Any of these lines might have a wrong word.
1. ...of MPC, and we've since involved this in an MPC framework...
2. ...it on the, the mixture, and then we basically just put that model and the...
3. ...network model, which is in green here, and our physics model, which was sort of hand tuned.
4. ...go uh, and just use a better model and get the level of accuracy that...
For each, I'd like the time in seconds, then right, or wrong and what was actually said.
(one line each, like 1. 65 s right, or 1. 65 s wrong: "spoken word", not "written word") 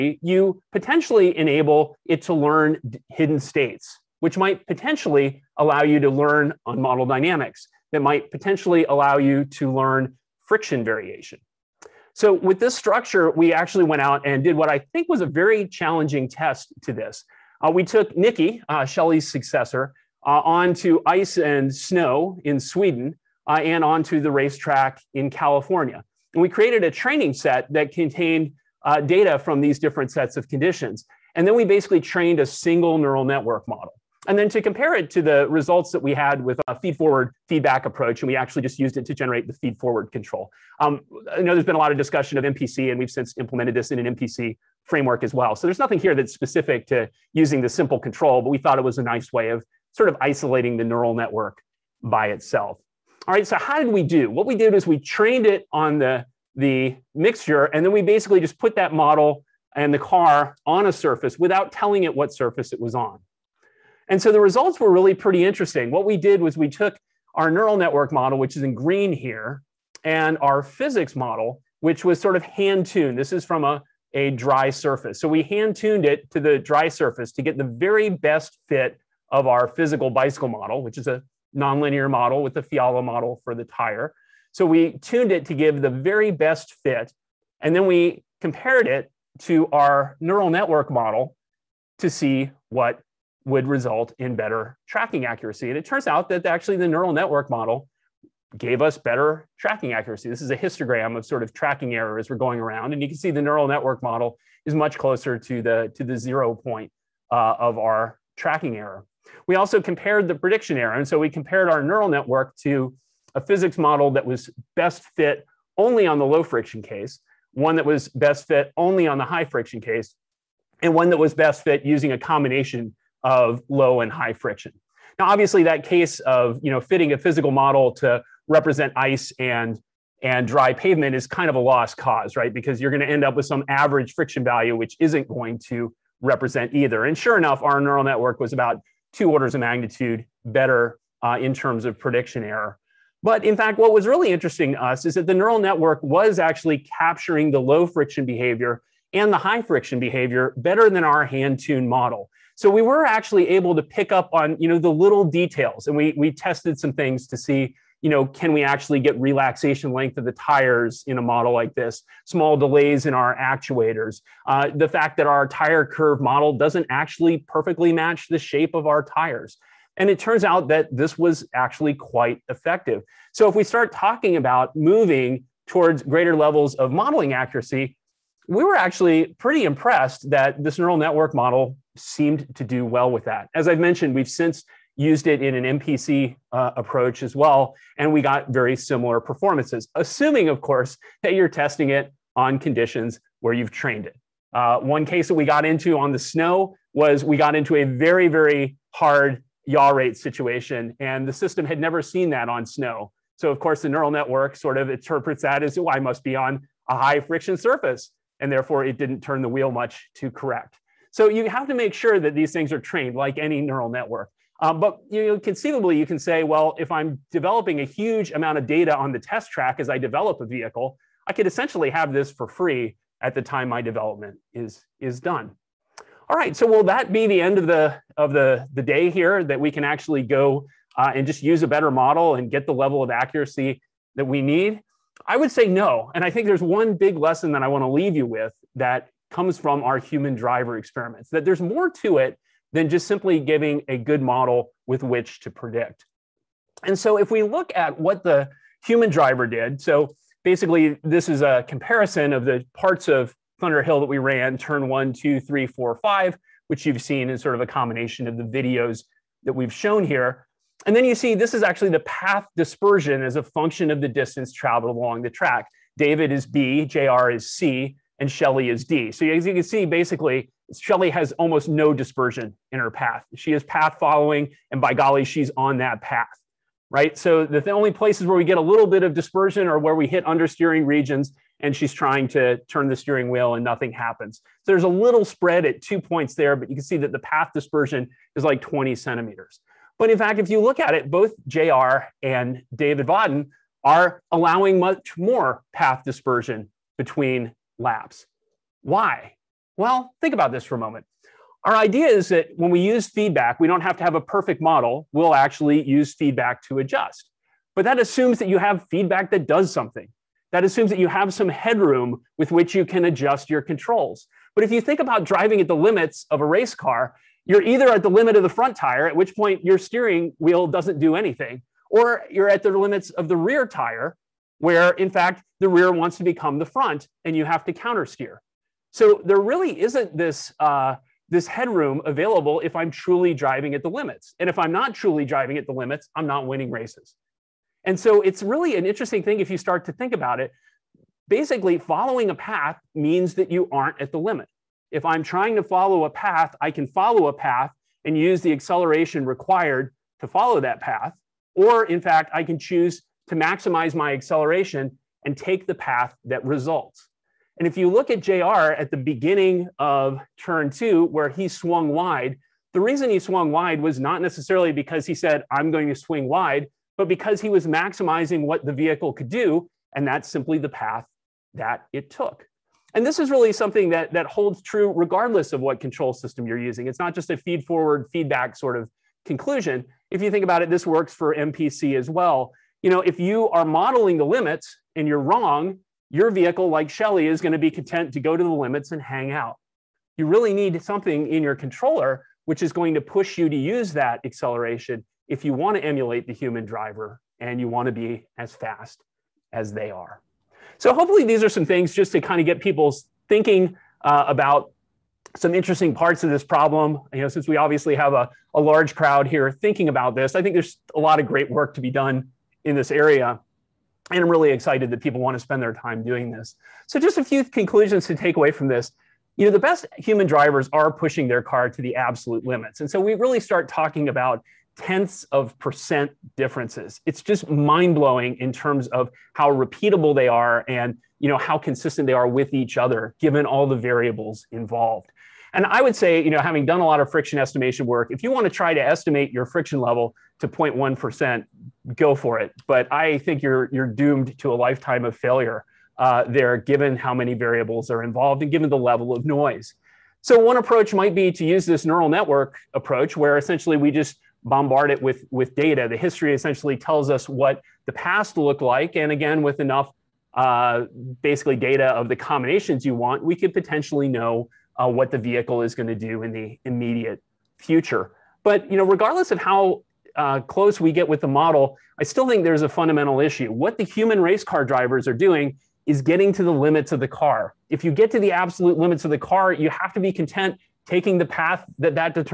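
1. 42 s wrong: "implemented", not "involved"
2. 55 s right
3. 67 s right
4. 230 s right.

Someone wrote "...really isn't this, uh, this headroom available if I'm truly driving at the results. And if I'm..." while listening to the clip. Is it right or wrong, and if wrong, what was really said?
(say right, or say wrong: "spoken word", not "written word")
wrong: "limits", not "results".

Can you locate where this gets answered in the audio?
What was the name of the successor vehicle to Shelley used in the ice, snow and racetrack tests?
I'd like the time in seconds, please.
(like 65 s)
18 s.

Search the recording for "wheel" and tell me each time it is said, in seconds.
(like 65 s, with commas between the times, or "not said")
209 s, 283 s, 320 s.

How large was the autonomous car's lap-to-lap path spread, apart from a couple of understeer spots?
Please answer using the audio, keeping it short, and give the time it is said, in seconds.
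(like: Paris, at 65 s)
20 centimeters, at 288 s.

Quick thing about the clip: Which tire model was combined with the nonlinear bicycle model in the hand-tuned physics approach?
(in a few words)
Fiala model.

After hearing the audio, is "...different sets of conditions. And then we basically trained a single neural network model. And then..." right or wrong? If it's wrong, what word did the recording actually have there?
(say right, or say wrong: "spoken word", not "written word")
right.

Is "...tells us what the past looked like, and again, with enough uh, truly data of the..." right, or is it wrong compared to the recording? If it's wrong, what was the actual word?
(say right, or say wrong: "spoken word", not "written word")
wrong: "basically", not "truly".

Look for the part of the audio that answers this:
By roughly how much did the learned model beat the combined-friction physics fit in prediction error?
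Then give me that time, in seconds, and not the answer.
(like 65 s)
139 s.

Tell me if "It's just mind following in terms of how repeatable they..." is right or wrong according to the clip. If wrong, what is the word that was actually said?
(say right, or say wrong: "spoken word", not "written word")
wrong: "blowing", not "following".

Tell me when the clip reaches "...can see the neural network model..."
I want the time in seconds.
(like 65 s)
103 s.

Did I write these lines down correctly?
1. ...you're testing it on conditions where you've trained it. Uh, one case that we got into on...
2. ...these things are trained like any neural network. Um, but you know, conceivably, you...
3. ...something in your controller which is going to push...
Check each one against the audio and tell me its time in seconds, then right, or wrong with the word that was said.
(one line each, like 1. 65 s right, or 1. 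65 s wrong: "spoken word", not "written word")
1. 191 s right
2. 212 s right
3. 390 s right.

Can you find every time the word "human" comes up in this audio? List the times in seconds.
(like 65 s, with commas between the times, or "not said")
239 s, 248 s, 396 s, 419 s, 473 s.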